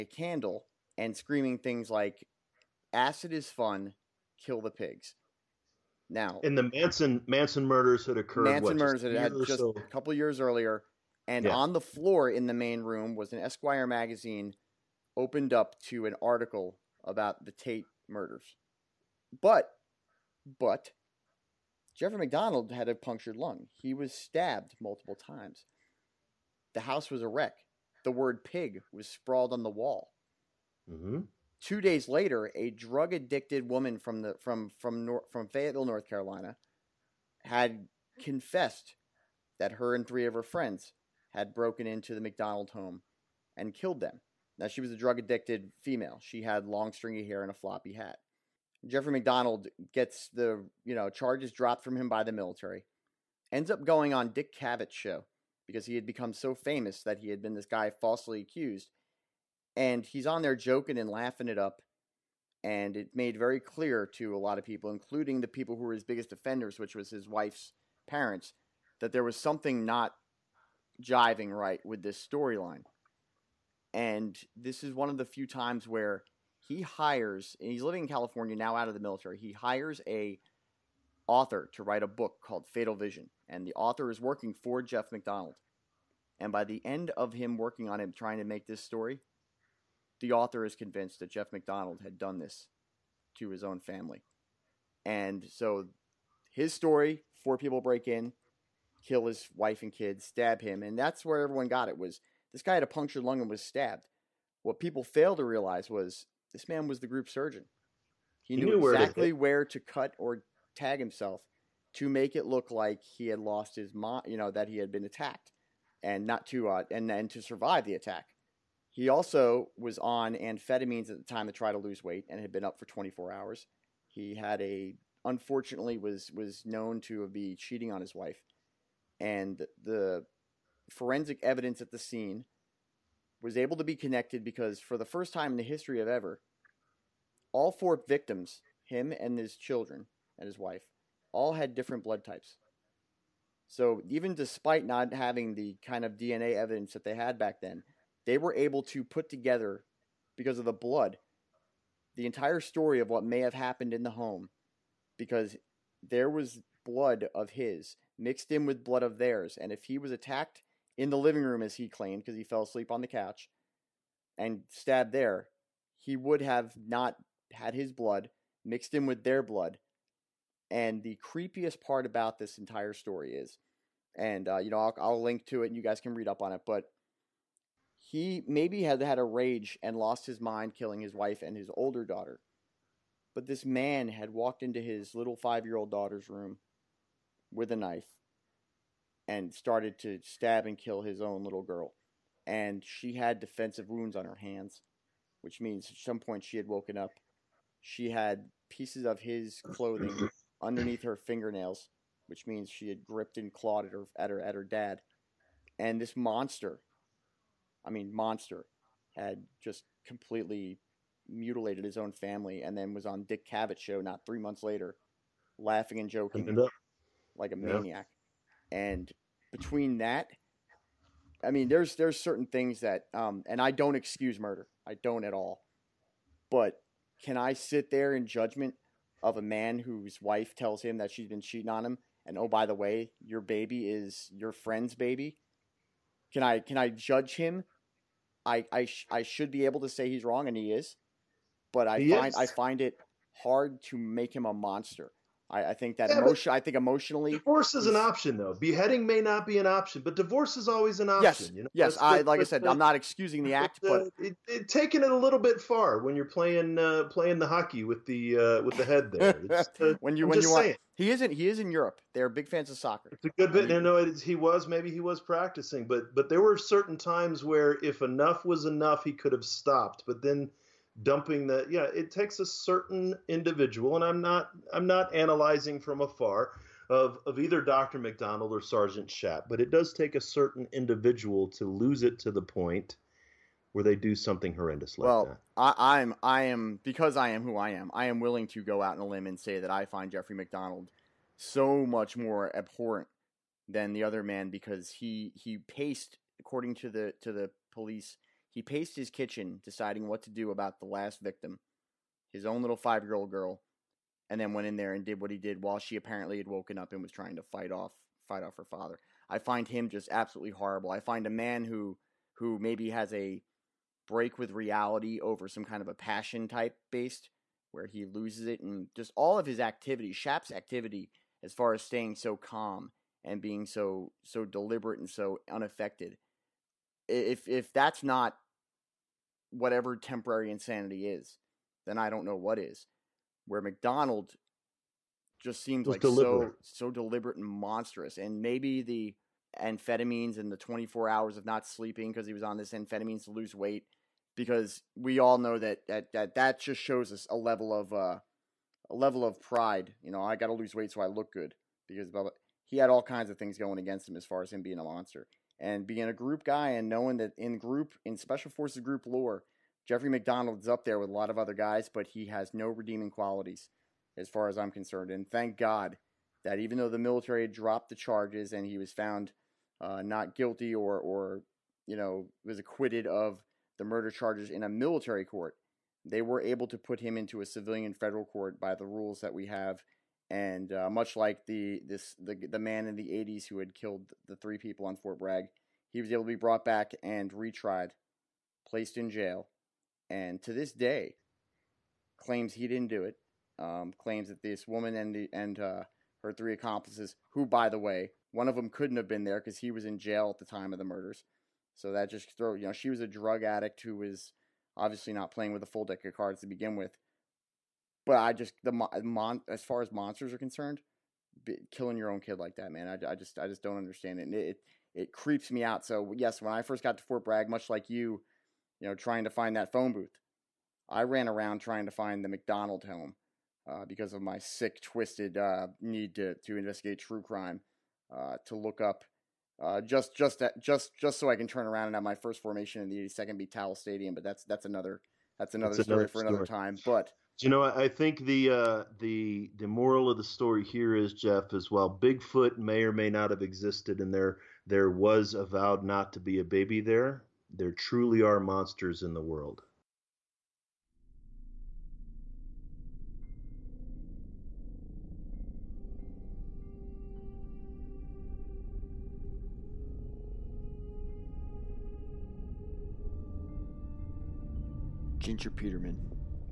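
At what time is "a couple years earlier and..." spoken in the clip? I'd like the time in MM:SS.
00:09.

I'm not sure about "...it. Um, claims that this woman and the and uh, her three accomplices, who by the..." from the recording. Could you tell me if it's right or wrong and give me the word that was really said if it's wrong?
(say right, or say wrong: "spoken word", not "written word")
right.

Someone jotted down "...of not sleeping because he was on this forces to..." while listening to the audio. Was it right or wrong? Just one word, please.
wrong.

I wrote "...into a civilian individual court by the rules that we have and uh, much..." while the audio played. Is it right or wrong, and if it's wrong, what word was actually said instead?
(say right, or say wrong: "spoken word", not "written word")
wrong: "federal", not "individual".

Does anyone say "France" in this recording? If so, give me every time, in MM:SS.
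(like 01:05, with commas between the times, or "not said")
not said.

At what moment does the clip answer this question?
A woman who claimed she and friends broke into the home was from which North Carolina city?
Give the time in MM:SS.
00:35.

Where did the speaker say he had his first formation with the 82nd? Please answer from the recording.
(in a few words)
Towle Stadium.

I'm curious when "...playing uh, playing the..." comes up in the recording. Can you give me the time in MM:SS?
04:16.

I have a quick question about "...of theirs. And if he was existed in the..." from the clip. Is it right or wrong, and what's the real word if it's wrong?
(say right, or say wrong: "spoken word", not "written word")
wrong: "attacked", not "existed".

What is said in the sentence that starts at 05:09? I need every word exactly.
I find him just absolutely horrible.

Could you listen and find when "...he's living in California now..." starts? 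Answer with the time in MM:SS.
01:17.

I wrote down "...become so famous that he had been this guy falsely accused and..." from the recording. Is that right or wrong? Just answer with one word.
right.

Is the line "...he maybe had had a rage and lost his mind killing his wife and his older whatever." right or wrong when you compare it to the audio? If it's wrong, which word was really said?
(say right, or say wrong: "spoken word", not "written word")
wrong: "daughter", not "whatever".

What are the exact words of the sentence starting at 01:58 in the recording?
He also was on amphetamines at the time to try to lose weight and had been up for 24 hours.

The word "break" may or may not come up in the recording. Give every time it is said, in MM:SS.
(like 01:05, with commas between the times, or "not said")
01:37, 05:14.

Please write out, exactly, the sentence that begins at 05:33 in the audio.
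Where MacDonald just seemed like deliberate.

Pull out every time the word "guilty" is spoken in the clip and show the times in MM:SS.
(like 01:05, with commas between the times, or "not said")
06:10.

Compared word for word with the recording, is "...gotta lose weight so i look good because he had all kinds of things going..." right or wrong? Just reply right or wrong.
right.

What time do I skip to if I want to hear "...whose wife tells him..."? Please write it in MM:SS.
03:49.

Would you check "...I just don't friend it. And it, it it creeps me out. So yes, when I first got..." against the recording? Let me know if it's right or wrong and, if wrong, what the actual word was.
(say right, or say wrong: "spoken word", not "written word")
wrong: "understand", not "friend".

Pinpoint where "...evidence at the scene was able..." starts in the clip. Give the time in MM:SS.
02:11.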